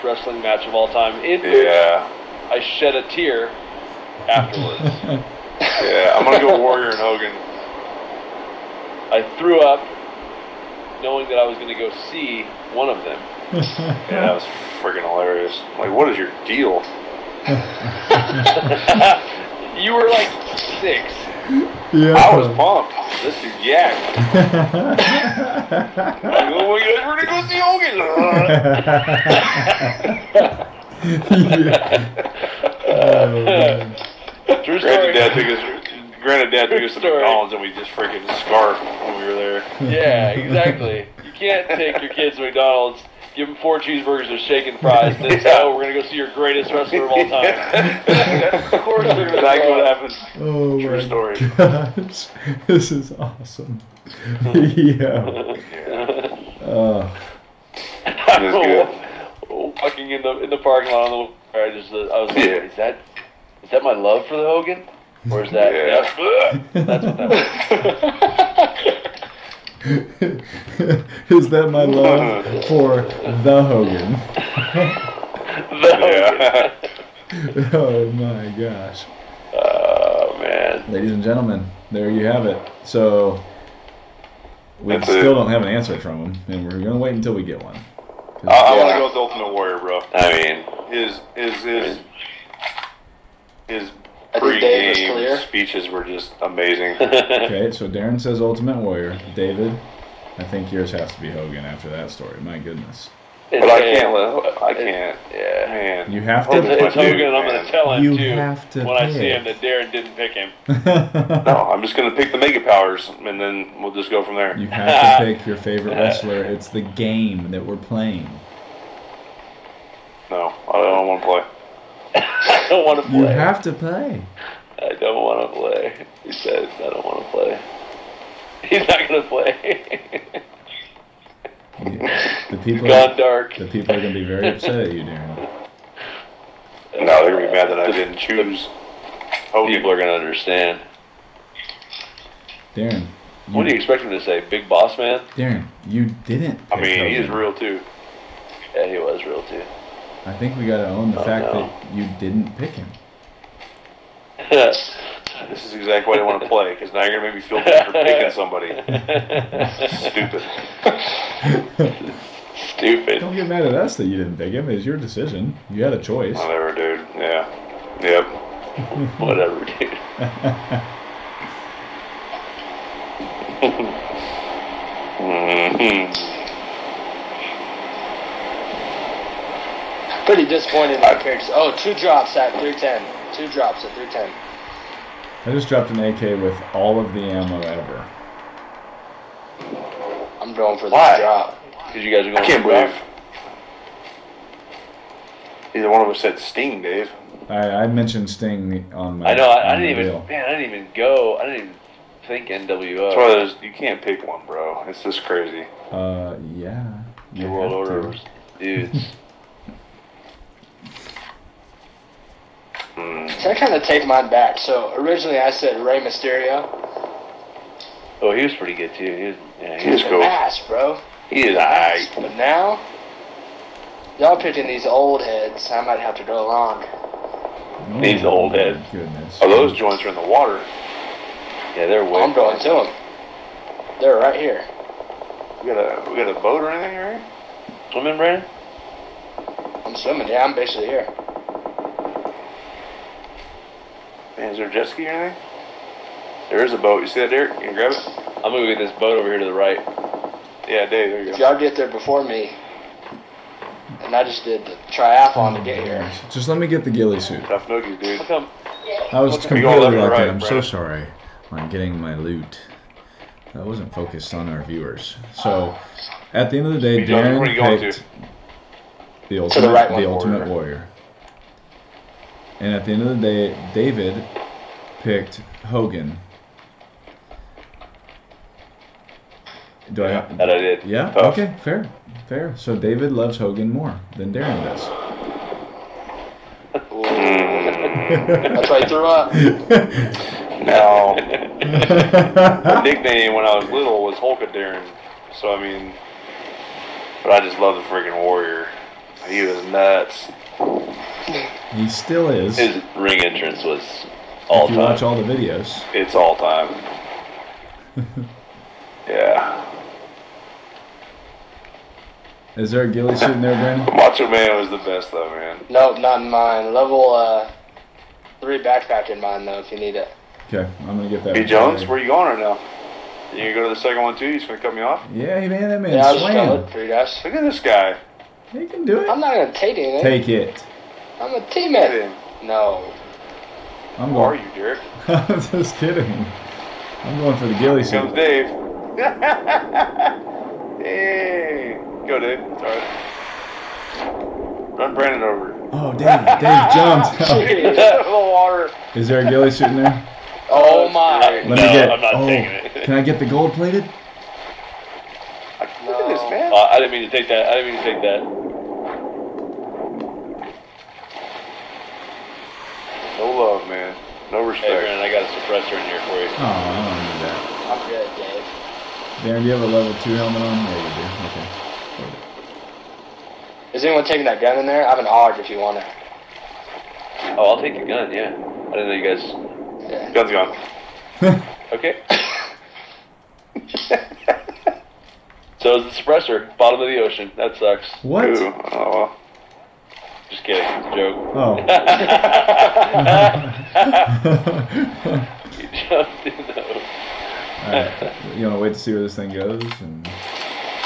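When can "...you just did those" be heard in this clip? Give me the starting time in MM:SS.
06:35.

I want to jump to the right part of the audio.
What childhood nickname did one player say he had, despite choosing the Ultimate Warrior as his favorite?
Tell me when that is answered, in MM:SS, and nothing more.
04:54.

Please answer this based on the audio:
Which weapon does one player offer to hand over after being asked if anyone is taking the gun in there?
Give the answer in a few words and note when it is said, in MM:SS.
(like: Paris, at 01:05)
AUG, at 06:15.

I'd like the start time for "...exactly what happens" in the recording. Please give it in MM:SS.
00:49.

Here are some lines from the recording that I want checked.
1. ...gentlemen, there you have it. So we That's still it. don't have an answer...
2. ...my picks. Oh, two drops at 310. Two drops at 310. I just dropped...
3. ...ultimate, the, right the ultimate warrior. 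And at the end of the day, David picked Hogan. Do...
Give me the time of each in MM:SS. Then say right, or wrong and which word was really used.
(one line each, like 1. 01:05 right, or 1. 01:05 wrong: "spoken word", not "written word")
1. 01:21 right
2. 03:01 right
3. 04:29 right.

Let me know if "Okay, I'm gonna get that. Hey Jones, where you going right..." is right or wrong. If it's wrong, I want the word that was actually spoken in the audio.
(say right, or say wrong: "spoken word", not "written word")
right.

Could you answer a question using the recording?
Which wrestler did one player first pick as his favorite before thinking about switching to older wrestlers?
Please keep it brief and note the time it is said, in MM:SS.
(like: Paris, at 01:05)
Rey Mysterio, at 03:35.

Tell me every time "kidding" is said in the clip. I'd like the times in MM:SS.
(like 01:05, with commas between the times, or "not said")
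05:35, 06:30.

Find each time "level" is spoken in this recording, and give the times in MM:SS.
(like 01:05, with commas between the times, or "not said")
05:16, 06:09.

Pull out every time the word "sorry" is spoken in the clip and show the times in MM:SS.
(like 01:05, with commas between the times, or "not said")
04:20, 05:42.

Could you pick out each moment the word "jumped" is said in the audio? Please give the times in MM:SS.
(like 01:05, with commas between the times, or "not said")
05:46.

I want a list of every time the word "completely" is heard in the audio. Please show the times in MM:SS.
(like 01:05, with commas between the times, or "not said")
04:19.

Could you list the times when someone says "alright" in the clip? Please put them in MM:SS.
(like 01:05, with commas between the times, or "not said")
03:41.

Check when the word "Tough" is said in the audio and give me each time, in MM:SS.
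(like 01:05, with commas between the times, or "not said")
04:17.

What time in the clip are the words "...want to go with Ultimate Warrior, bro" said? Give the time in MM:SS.
01:28.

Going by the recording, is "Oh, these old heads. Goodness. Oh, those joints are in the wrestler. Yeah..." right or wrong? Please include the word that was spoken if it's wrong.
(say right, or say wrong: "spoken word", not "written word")
wrong: "water", not "wrestler".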